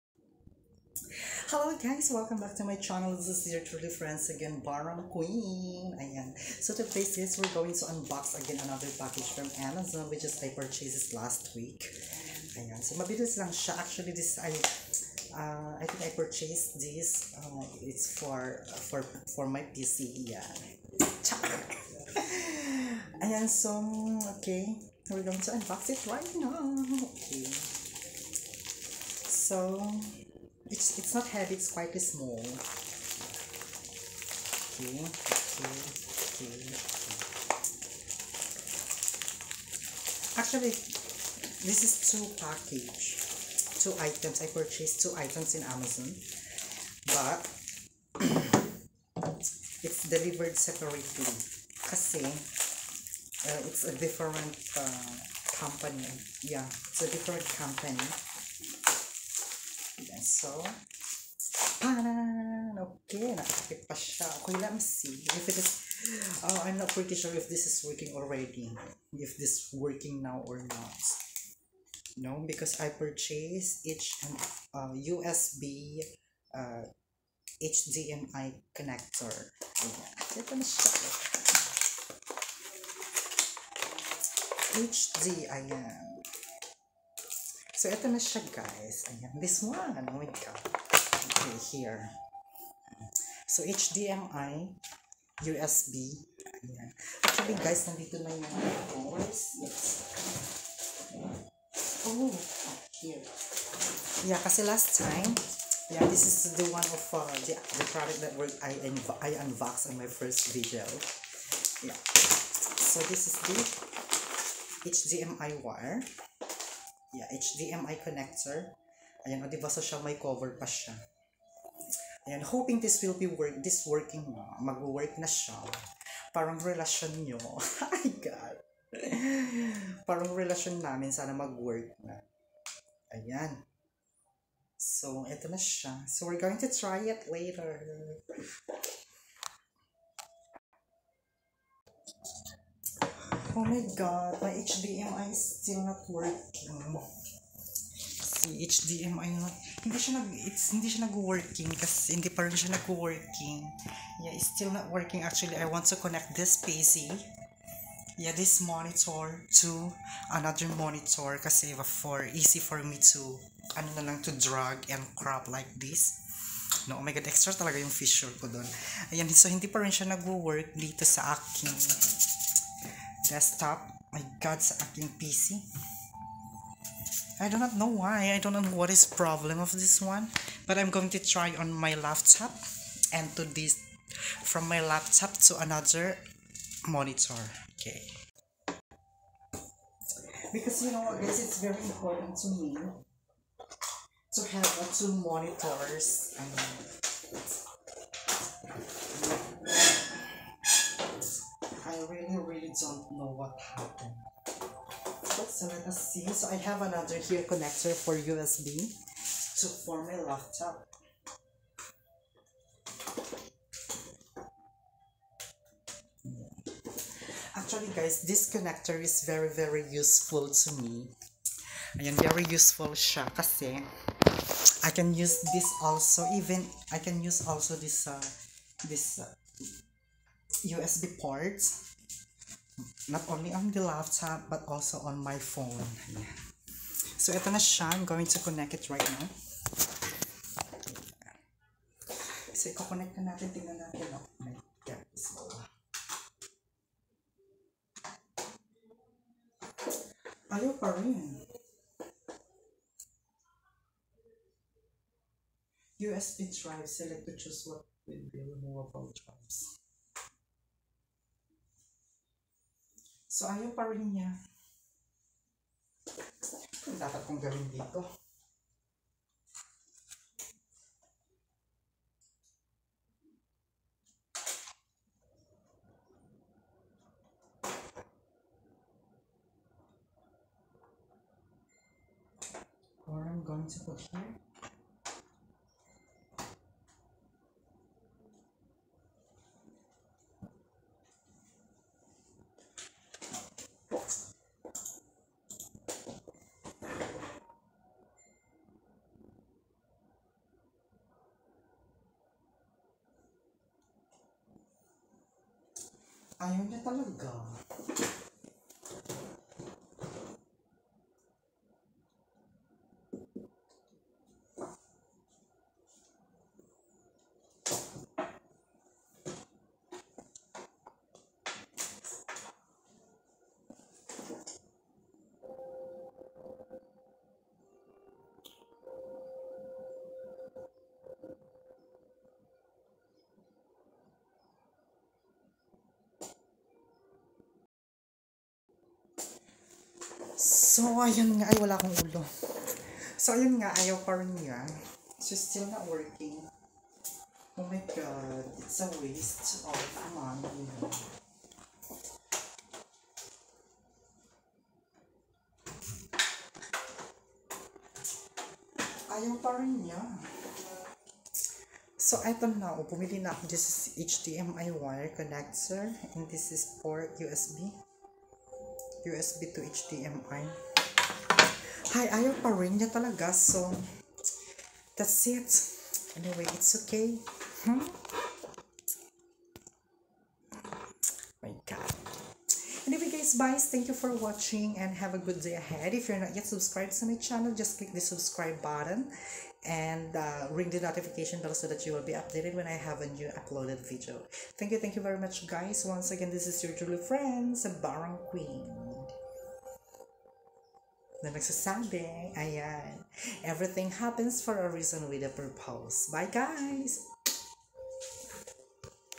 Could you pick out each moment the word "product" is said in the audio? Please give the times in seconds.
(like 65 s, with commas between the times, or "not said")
107 s.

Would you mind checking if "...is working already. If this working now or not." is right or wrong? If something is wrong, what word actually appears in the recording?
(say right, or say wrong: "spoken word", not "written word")
right.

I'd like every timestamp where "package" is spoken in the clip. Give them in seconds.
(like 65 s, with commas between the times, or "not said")
8 s, 42 s.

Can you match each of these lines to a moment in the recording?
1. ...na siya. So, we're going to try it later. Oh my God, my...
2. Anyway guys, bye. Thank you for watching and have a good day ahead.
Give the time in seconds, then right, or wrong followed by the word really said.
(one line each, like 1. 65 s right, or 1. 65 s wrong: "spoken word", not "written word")
1. 135 s right
2. 382 s right.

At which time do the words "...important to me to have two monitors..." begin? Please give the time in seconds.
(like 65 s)
191 s.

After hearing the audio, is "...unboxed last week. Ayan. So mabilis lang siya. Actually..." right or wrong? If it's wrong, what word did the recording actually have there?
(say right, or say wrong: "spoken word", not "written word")
wrong: "purchased", not "unboxed".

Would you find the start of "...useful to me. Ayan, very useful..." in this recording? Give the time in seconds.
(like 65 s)
219 s.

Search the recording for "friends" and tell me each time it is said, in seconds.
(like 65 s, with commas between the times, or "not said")
3 s, 396 s.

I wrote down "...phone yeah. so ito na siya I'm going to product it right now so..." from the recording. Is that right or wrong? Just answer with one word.
wrong.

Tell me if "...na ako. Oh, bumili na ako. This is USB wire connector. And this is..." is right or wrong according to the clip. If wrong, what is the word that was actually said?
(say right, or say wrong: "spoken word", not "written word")
wrong: "HDMI", not "USB".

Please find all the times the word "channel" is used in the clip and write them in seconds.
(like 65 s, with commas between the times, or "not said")
2 s, 387 s.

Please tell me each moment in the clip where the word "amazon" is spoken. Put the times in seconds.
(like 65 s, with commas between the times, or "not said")
9 s, 45 s.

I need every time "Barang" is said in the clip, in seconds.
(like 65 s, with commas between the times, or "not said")
4 s, 397 s.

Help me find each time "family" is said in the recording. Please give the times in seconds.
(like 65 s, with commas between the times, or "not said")
not said.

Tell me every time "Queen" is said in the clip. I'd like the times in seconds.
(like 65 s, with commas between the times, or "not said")
5 s, 398 s.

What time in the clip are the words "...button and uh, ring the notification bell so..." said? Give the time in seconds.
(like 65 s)
388 s.